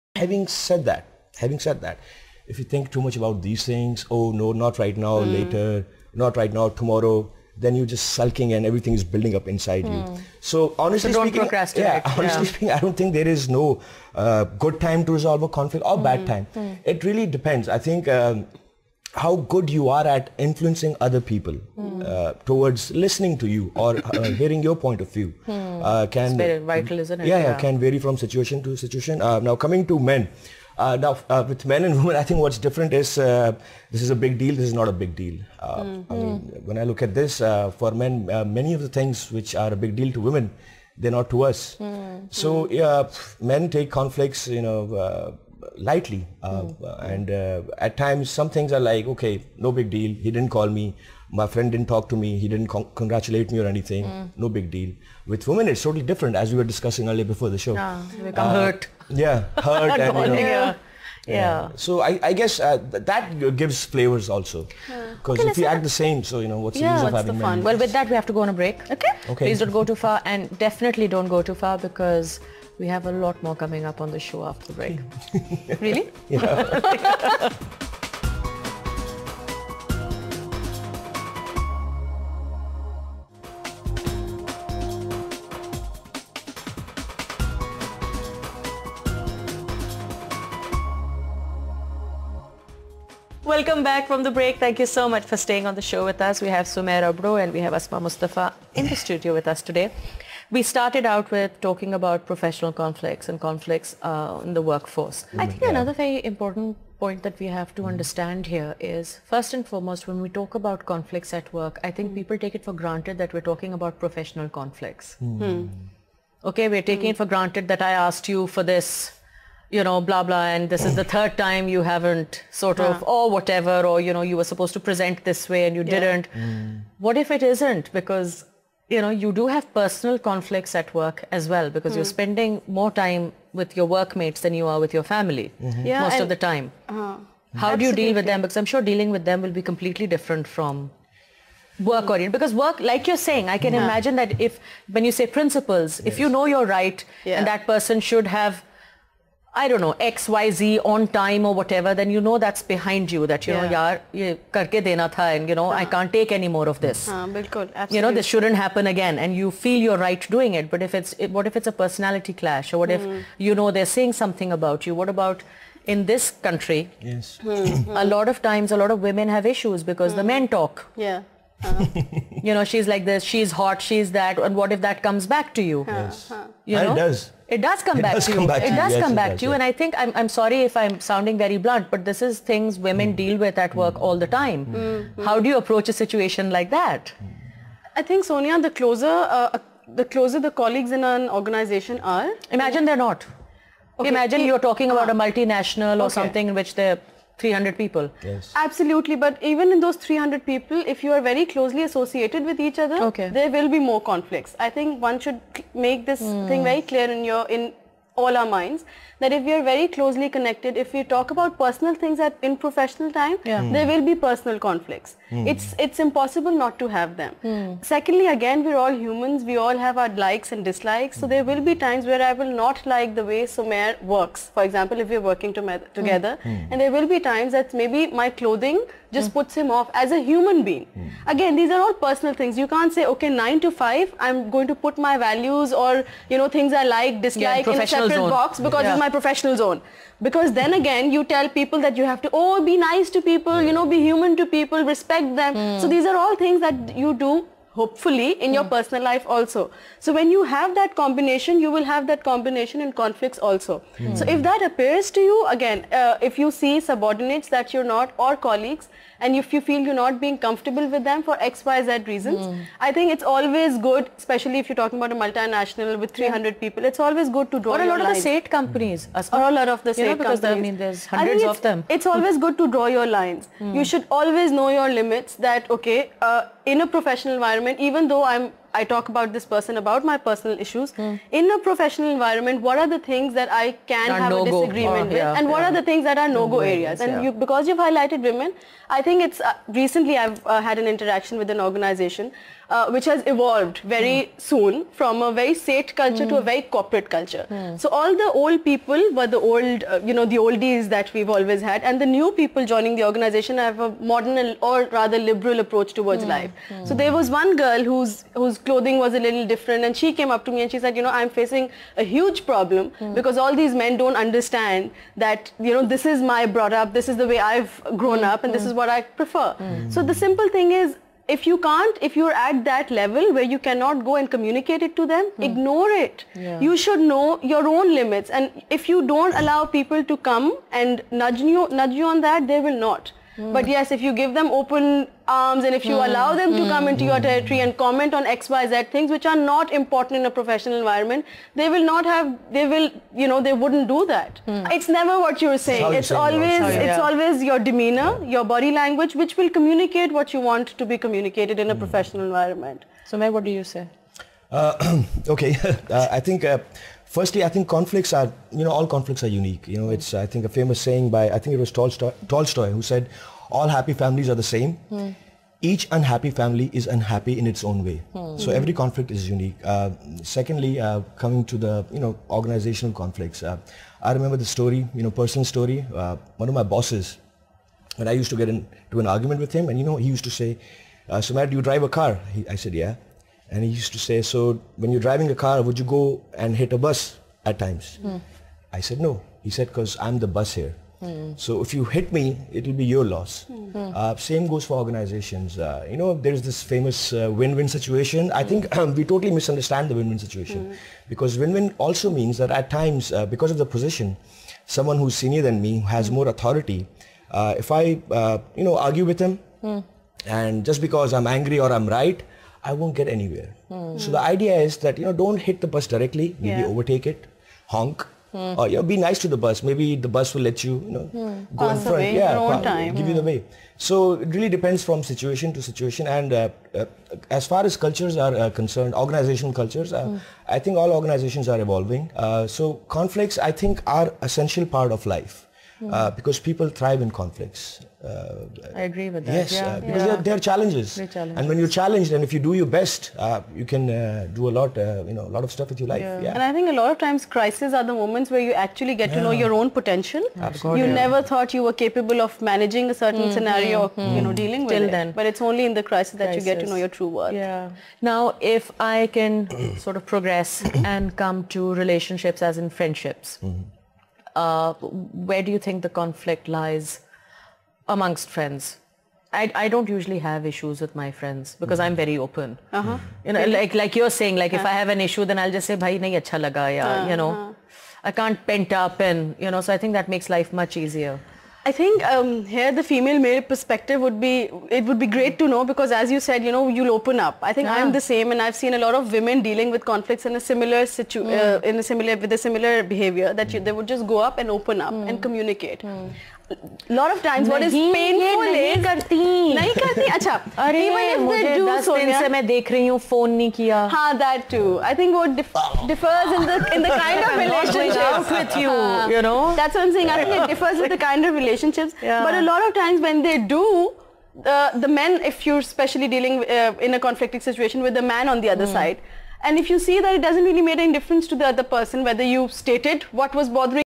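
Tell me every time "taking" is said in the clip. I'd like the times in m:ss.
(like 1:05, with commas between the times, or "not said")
1:56.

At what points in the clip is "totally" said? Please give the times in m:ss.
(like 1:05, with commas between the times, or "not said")
0:55, 6:39.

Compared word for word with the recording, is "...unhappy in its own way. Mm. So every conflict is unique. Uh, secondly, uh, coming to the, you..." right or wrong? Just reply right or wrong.
right.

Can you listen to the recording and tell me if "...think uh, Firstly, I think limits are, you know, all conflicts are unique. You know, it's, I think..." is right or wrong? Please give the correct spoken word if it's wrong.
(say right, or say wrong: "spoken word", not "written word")
wrong: "conflicts", not "limits".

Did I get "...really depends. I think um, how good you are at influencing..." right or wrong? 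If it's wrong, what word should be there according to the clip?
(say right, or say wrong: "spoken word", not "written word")
right.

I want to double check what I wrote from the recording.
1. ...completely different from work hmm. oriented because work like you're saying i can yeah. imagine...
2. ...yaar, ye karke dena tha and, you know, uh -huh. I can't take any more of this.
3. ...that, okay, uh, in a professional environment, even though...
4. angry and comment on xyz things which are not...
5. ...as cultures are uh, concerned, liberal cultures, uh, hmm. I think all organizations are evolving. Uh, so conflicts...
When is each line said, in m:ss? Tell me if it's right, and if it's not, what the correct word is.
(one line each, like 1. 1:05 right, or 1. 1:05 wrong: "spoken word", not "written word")
1. 2:19 right
2. 2:33 right
3. 4:35 right
4. 5:37 wrong: "territory", not "angry"
5. 7:07 wrong: "organizational", not "liberal".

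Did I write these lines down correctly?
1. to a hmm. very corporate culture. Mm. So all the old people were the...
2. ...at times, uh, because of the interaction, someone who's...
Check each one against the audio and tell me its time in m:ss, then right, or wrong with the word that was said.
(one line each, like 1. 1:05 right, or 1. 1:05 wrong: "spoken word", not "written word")
1. 4:56 right
2. 6:42 wrong: "position", not "interaction".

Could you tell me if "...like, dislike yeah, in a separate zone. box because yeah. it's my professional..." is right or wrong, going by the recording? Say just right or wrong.
right.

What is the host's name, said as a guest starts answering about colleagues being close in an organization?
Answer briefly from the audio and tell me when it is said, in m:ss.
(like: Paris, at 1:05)
Sonia, at 3:08.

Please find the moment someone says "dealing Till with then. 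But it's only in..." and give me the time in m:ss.
7:34.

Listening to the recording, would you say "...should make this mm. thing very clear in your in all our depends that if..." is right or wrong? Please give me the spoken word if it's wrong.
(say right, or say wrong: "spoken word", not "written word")
wrong: "minds", not "depends".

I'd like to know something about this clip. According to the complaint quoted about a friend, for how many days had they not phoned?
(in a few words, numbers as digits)
10.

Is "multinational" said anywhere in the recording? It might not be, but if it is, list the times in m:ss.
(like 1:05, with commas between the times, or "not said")
3:15, 4:25.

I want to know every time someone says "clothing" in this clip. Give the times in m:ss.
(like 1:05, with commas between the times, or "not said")
3:48, 5:08.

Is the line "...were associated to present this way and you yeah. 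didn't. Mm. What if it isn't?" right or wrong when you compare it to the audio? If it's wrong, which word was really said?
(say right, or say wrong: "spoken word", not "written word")
wrong: "supposed", not "associated".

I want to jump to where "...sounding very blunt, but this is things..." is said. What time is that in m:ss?
3:01.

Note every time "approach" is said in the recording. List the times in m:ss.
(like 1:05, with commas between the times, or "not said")
3:05, 5:05.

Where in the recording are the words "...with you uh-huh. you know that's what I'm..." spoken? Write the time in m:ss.
8:28.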